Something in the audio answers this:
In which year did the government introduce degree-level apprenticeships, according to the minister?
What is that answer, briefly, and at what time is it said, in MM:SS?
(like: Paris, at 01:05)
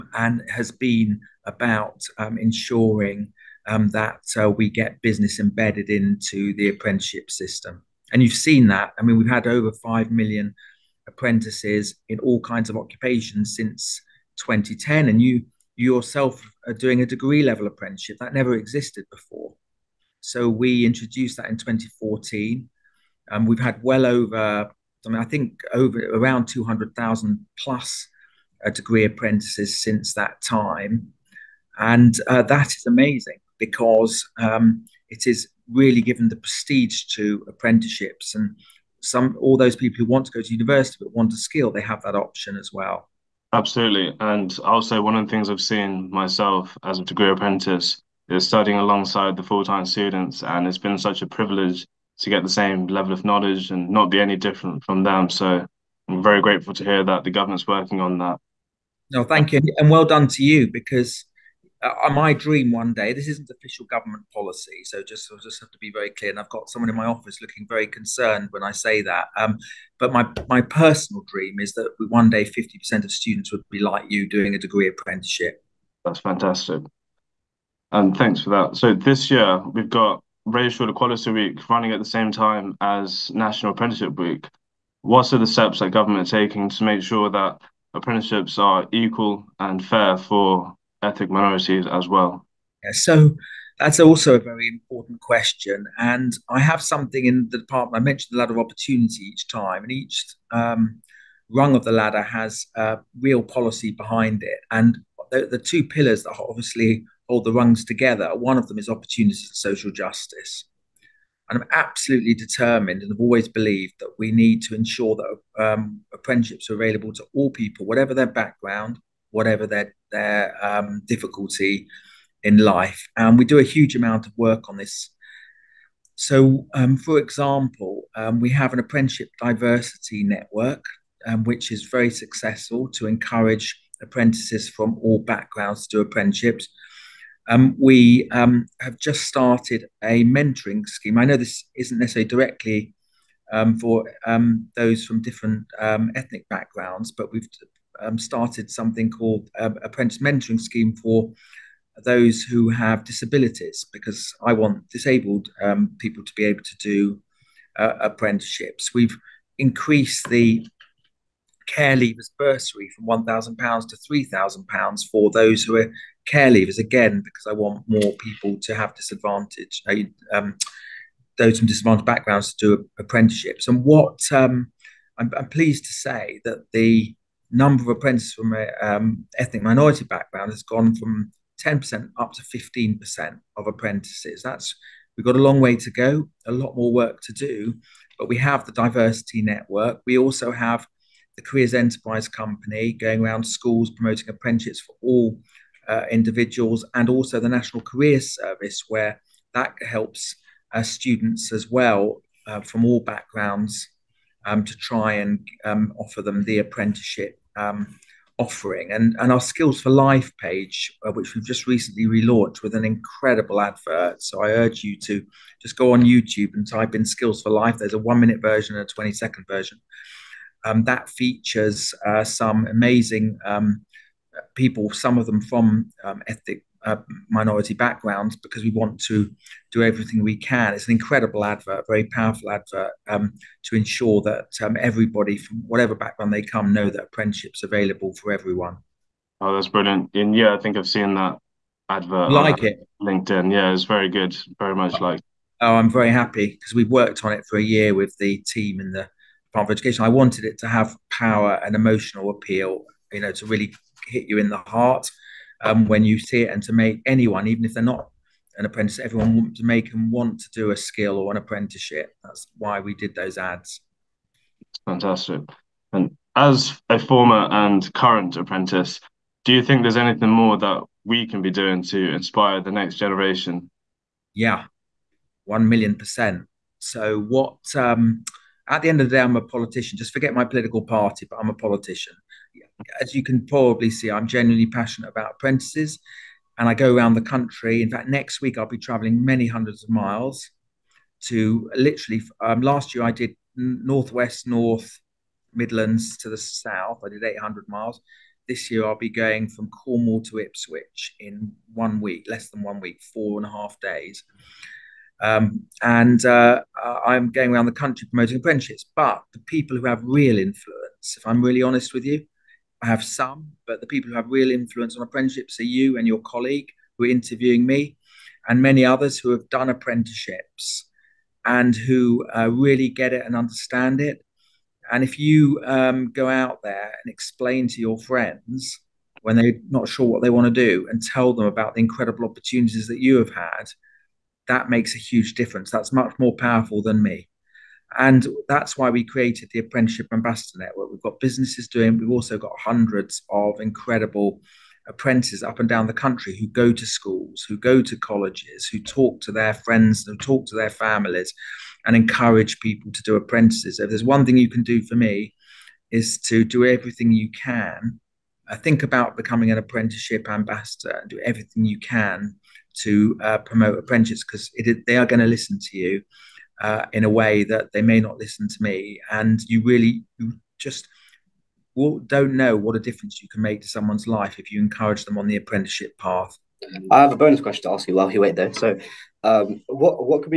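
2014, at 00:21.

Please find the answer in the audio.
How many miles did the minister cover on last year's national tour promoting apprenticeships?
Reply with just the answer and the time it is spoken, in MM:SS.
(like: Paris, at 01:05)
800 miles, at 04:57.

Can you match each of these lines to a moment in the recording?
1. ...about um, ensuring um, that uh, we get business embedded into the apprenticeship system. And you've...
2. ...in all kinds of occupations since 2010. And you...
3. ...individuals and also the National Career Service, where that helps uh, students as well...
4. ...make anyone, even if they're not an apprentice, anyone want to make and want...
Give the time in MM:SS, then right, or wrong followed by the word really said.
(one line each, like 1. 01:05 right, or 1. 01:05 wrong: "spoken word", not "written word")
1. 00:01 right
2. 00:12 right
3. 03:16 right
4. 04:16 wrong: "everyone", not "anyone".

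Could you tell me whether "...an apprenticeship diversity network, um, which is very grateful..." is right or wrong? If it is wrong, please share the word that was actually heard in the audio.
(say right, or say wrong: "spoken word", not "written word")
wrong: "successful", not "grateful".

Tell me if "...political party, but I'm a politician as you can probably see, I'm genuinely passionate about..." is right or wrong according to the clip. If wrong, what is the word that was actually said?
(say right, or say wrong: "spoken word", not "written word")
right.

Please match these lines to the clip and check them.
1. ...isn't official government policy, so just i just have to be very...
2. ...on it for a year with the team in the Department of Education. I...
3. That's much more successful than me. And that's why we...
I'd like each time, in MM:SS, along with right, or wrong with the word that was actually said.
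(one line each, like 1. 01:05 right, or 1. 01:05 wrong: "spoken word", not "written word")
1. 01:03 right
2. 04:07 right
3. 05:35 wrong: "powerful", not "successful".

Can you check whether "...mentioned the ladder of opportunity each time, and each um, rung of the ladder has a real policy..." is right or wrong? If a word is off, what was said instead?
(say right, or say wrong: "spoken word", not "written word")
right.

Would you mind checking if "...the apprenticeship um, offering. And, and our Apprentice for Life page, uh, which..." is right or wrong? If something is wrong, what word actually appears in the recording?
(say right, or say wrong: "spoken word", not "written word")
wrong: "Skills", not "Apprentice".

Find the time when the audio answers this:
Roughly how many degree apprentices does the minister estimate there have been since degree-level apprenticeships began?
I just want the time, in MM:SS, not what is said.
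00:26.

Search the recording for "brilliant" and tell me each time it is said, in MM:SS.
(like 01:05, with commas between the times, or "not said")
03:59.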